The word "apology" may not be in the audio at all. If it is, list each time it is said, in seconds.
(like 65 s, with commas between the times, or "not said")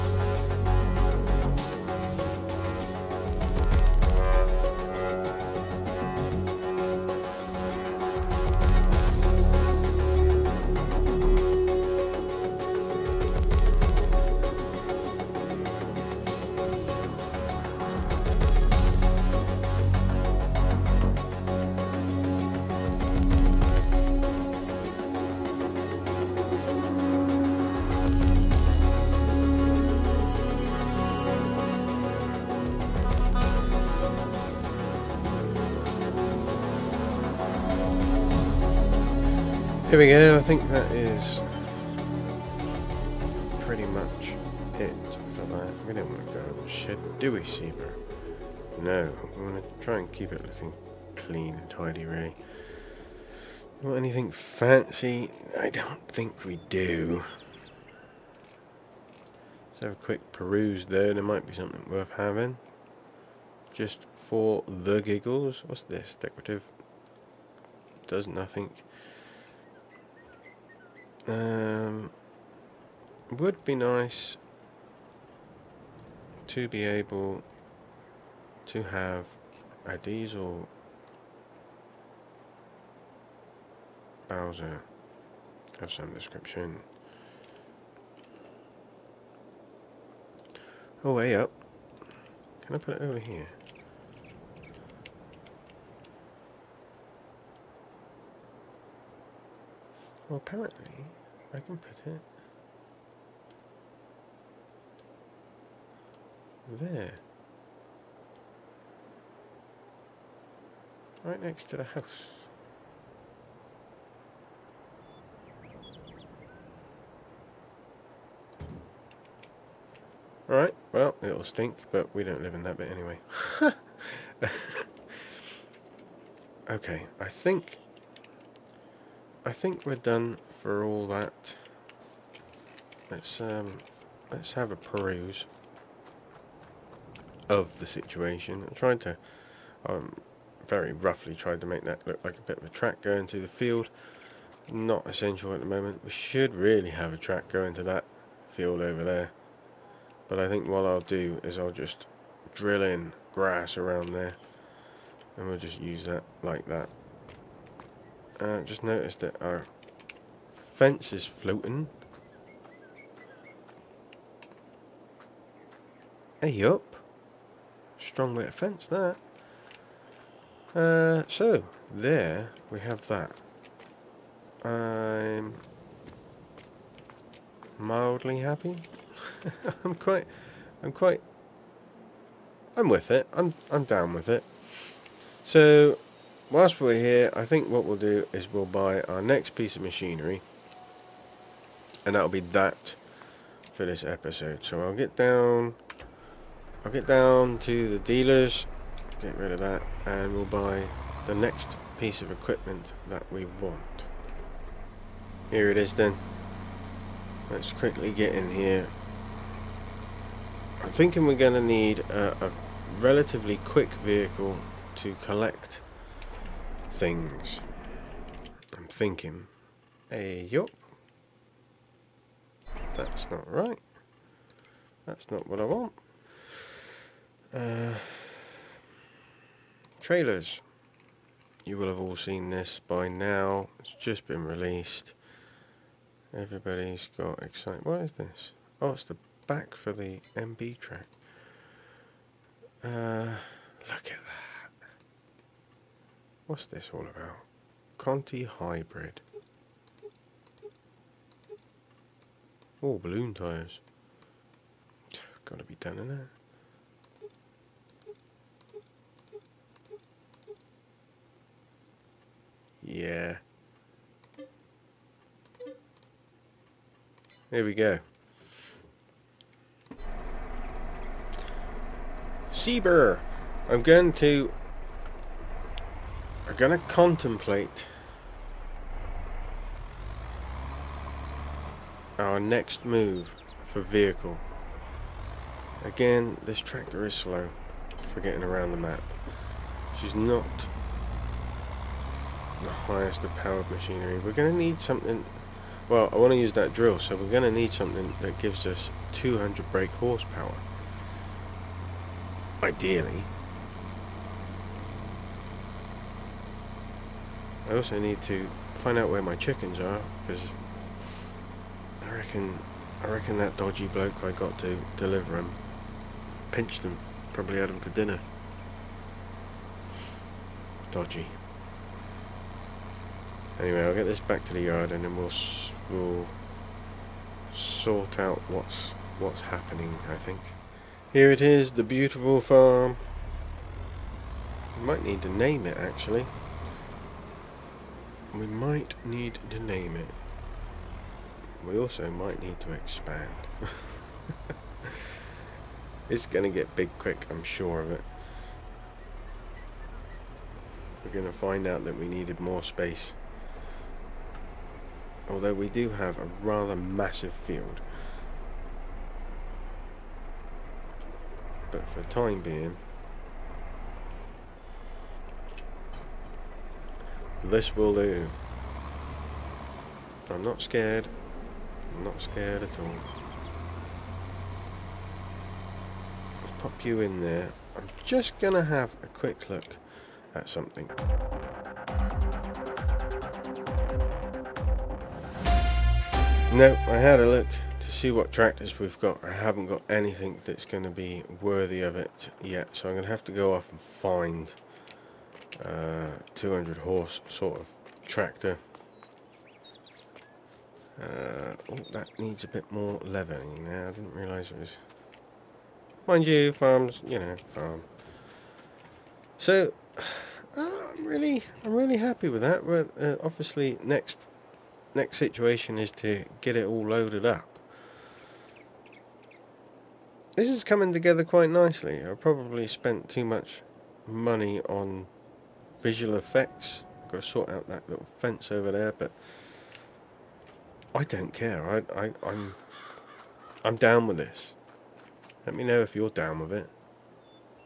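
not said.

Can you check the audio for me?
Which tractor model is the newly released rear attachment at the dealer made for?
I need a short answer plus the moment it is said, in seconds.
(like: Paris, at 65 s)
MB Trac, at 240 s.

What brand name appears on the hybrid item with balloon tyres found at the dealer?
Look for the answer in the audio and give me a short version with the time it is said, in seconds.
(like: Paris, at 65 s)
Conti, at 247 s.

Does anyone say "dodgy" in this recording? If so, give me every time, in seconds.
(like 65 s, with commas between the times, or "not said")
313 s, 320 s.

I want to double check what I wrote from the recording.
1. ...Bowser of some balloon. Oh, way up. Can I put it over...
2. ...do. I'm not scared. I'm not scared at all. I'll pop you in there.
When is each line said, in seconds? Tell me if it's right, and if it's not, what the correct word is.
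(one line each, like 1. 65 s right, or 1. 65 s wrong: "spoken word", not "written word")
1. 84 s wrong: "description", not "balloon"
2. 367 s right.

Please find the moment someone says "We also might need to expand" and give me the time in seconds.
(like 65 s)
341 s.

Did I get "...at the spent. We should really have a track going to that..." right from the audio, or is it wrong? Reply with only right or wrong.
wrong.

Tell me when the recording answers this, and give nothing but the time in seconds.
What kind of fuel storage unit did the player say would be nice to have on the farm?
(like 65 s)
79 s.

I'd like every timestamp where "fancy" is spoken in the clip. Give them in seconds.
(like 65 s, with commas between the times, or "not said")
54 s.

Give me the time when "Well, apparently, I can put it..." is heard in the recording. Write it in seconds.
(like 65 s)
100 s.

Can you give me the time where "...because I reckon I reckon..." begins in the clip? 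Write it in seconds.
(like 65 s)
310 s.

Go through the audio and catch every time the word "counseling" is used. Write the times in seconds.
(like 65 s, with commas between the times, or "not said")
not said.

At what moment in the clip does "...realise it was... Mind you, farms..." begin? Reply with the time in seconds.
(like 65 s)
404 s.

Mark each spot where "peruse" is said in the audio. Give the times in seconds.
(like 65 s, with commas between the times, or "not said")
60 s, 134 s.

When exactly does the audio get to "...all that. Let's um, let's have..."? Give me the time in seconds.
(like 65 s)
130 s.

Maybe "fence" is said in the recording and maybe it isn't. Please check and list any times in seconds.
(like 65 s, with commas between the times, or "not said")
160 s, 168 s, 428 s.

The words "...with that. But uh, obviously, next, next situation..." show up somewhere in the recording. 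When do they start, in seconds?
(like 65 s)
412 s.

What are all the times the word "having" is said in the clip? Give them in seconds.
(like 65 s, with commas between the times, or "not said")
62 s.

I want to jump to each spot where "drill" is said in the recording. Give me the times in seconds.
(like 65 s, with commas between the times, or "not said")
152 s, 296 s.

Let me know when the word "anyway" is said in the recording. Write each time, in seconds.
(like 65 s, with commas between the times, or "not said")
122 s, 323 s.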